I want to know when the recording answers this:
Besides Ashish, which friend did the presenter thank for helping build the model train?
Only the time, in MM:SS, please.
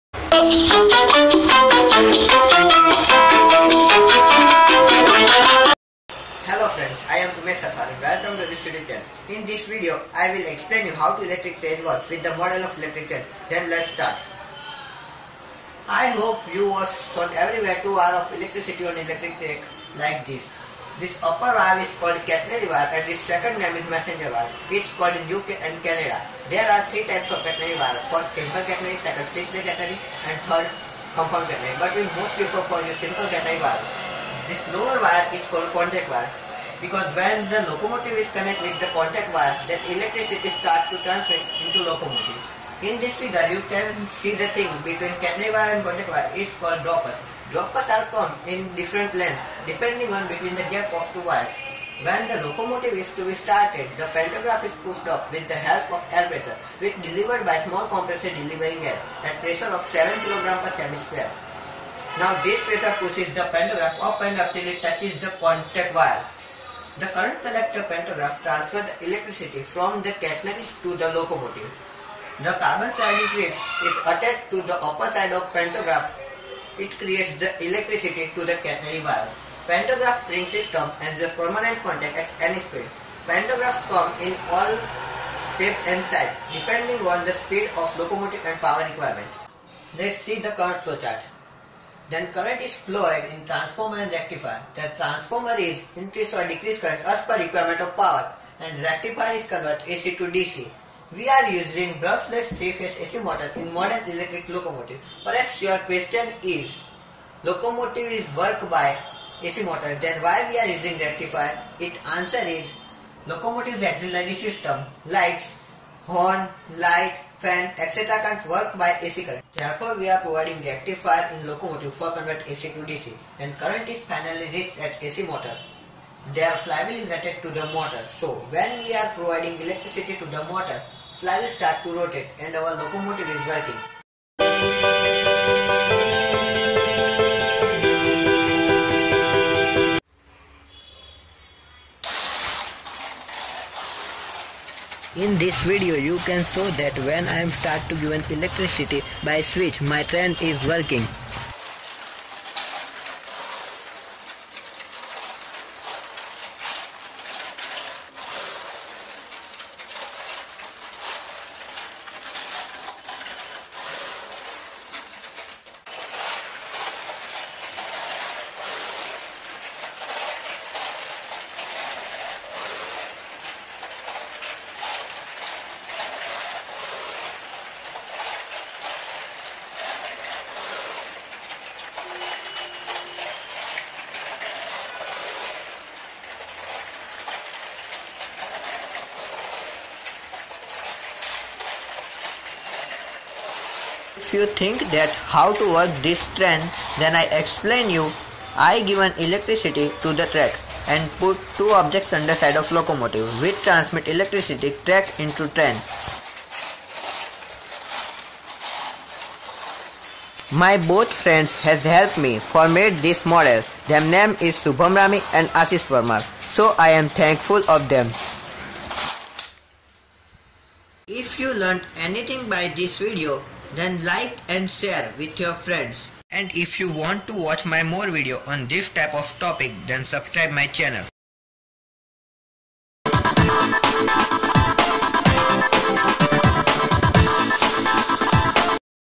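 03:34.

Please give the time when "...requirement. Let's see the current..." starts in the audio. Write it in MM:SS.
01:28.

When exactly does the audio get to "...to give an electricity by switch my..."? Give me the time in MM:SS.
02:27.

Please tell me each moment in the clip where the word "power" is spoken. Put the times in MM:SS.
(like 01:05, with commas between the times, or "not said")
01:28, 01:37.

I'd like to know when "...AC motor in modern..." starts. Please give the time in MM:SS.
01:43.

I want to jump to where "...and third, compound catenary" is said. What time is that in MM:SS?
00:30.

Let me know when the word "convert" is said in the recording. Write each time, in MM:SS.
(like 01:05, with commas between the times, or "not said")
01:39, 02:02.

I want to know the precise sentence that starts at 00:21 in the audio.
This upper valve is called catenary valve and its second name is messenger valve.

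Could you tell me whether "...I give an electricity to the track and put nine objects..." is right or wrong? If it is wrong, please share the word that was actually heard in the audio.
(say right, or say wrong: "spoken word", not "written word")
wrong: "two", not "nine".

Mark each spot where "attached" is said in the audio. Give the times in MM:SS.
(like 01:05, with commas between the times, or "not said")
01:14, 02:07.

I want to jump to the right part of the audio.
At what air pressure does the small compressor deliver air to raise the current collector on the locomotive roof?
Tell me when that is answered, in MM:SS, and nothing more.
00:59.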